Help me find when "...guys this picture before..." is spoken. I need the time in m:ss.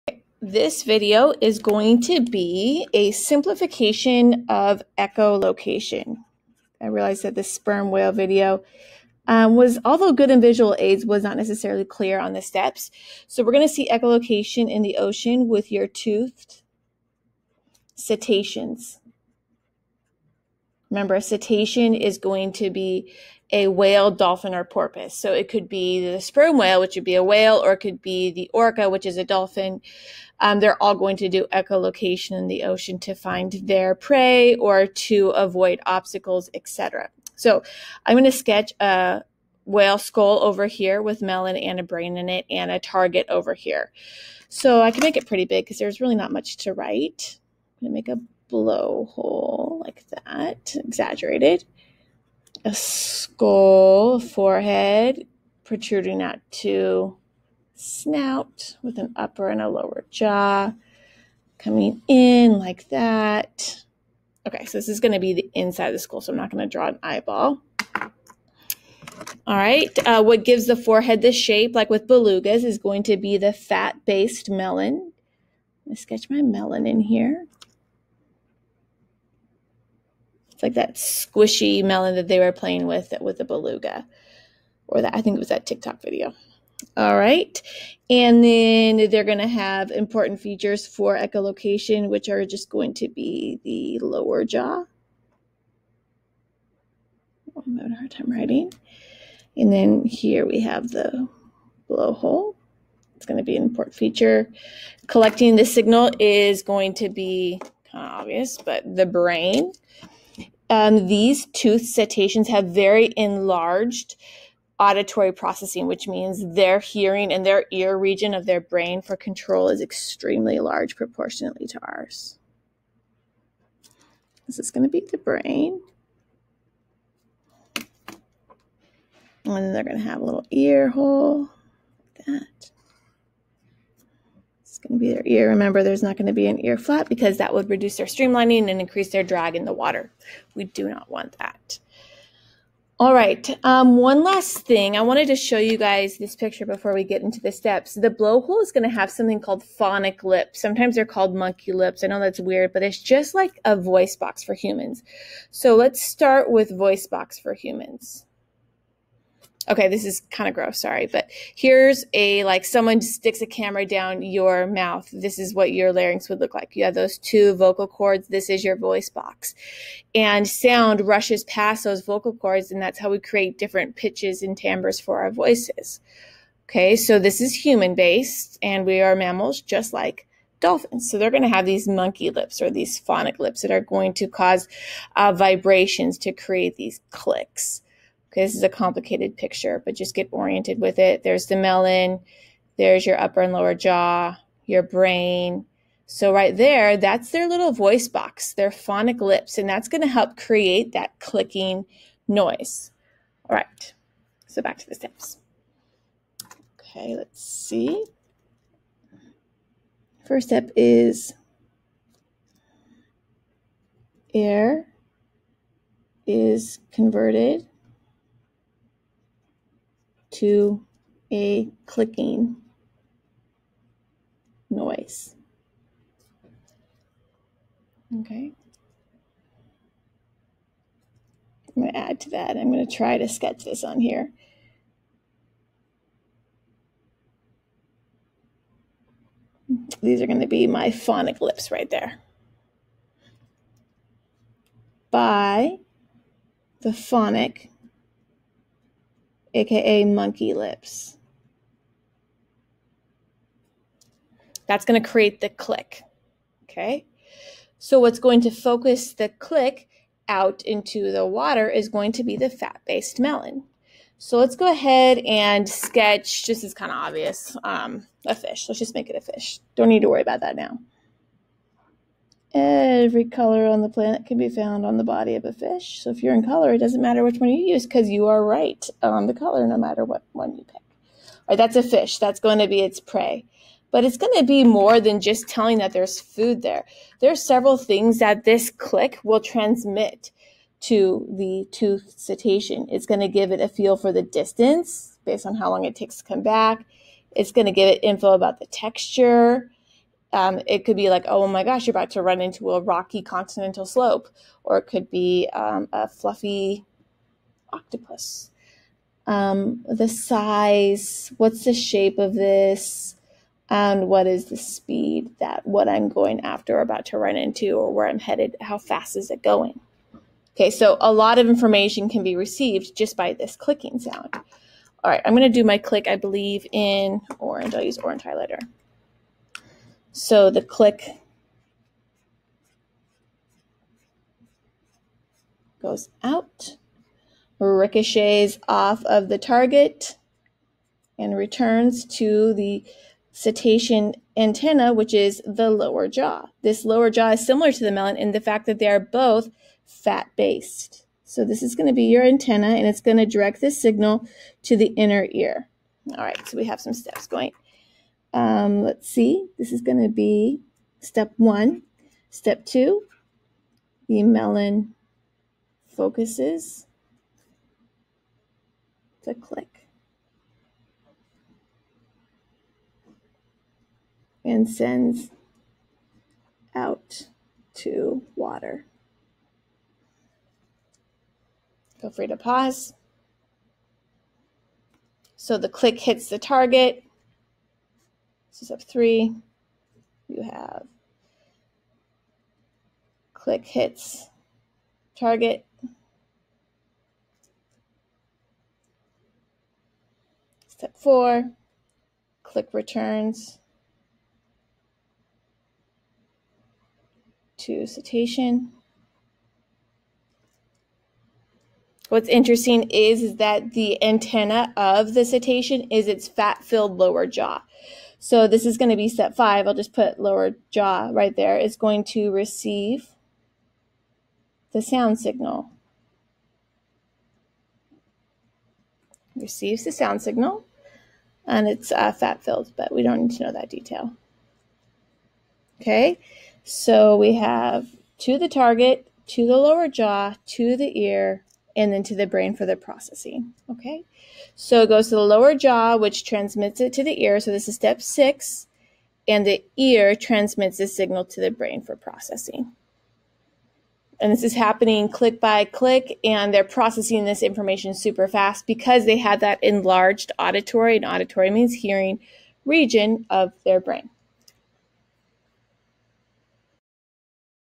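2:25.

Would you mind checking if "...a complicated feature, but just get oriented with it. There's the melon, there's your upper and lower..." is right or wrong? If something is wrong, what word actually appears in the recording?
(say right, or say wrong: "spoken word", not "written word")
wrong: "picture", not "feature".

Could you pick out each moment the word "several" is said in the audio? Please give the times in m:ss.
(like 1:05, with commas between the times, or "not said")
4:47.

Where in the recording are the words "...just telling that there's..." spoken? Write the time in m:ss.
4:45.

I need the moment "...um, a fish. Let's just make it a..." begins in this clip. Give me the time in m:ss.
4:27.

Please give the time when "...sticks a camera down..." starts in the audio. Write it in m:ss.
2:43.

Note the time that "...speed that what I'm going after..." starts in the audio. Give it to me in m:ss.
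5:14.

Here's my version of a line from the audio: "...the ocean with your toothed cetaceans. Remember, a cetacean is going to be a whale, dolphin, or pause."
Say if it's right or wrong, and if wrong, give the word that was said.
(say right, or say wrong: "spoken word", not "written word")
wrong: "porpoise", not "pause".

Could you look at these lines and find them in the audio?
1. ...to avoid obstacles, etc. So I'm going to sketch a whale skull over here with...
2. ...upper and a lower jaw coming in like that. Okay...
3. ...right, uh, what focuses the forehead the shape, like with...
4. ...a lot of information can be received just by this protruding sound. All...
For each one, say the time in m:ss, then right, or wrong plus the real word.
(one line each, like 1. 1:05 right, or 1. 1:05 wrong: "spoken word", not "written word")
1. 0:34 right
2. 0:59 right
3. 1:09 wrong: "gives", not "focuses"
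4. 5:21 wrong: "clicking", not "protruding".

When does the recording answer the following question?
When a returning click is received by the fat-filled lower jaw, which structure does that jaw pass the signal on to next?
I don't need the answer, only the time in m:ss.
5:54.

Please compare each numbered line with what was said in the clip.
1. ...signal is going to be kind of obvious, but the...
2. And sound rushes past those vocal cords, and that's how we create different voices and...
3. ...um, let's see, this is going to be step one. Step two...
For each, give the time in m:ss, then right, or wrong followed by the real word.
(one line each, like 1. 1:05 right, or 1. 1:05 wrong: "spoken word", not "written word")
1. 1:45 right
2. 2:50 wrong: "pitches", not "voices"
3. 5:58 right.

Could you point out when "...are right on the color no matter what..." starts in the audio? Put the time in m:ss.
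4:38.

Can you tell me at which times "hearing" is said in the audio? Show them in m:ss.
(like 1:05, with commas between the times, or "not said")
1:56, 7:41.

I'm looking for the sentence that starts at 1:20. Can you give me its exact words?
It's like that squishy melon that they were playing with with the beluga, or that I think it was that TikTok video.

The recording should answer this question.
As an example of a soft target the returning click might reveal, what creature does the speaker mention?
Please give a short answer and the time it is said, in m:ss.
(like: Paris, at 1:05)
fluffy octopus, at 5:06.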